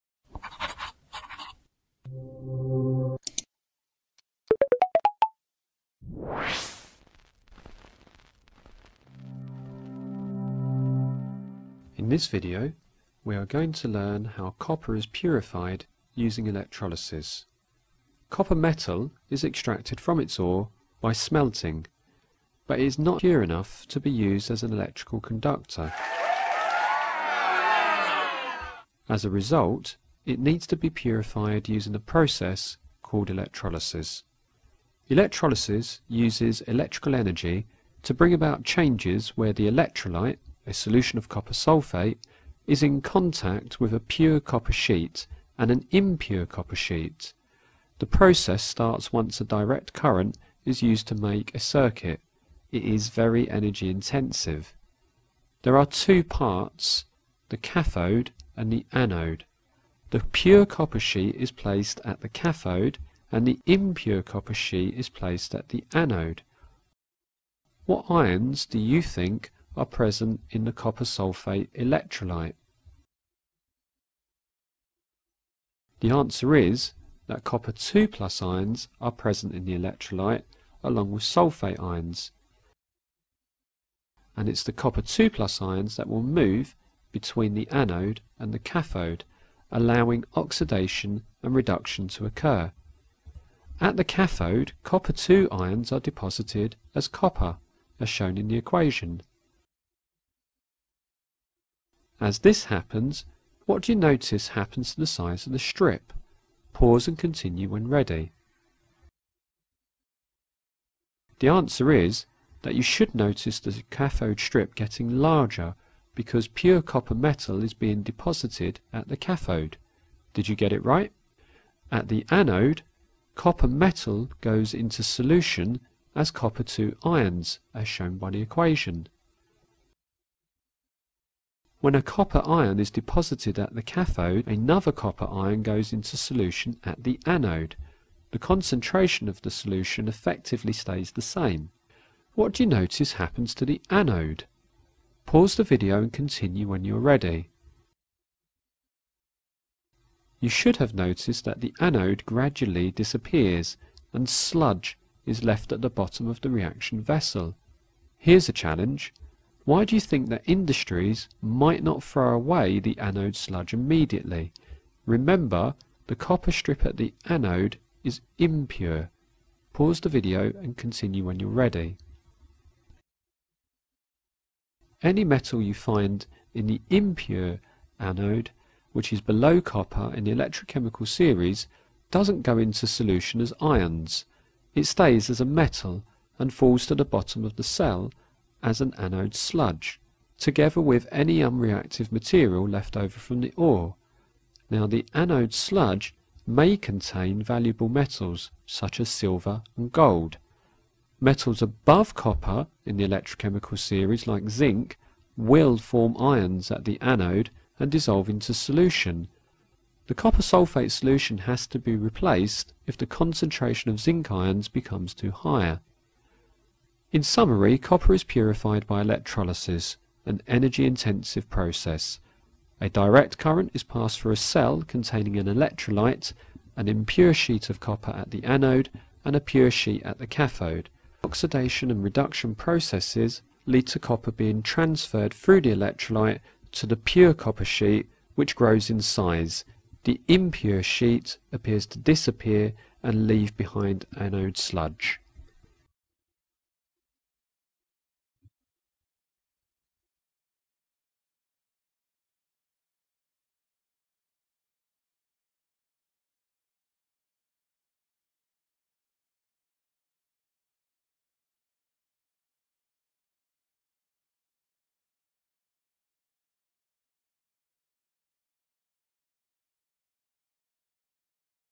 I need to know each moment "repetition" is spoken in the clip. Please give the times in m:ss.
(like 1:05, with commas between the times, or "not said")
not said.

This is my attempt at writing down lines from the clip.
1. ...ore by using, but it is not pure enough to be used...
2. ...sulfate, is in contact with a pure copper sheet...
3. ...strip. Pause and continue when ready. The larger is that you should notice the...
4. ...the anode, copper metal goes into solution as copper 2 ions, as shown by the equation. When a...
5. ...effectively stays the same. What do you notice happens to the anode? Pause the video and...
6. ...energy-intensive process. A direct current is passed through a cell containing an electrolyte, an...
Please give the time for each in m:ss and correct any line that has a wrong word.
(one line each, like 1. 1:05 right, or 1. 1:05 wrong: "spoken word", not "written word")
1. 0:20 wrong: "smelting", not "using"
2. 0:41 right
3. 1:45 wrong: "answer", not "larger"
4. 2:02 right
5. 2:20 right
6. 3:40 right.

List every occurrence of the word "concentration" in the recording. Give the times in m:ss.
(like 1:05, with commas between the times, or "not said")
2:18, 3:33.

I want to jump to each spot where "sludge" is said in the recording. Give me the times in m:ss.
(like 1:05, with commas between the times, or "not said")
2:34, 2:43, 3:09, 3:15, 4:04.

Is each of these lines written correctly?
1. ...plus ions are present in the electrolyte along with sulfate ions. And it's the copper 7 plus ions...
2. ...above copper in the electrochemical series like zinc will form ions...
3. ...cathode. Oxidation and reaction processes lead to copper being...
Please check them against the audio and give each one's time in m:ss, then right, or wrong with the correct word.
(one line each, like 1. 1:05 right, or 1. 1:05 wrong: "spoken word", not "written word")
1. 1:18 wrong: "2", not "7"
2. 3:21 right
3. 3:50 wrong: "reduction", not "reaction".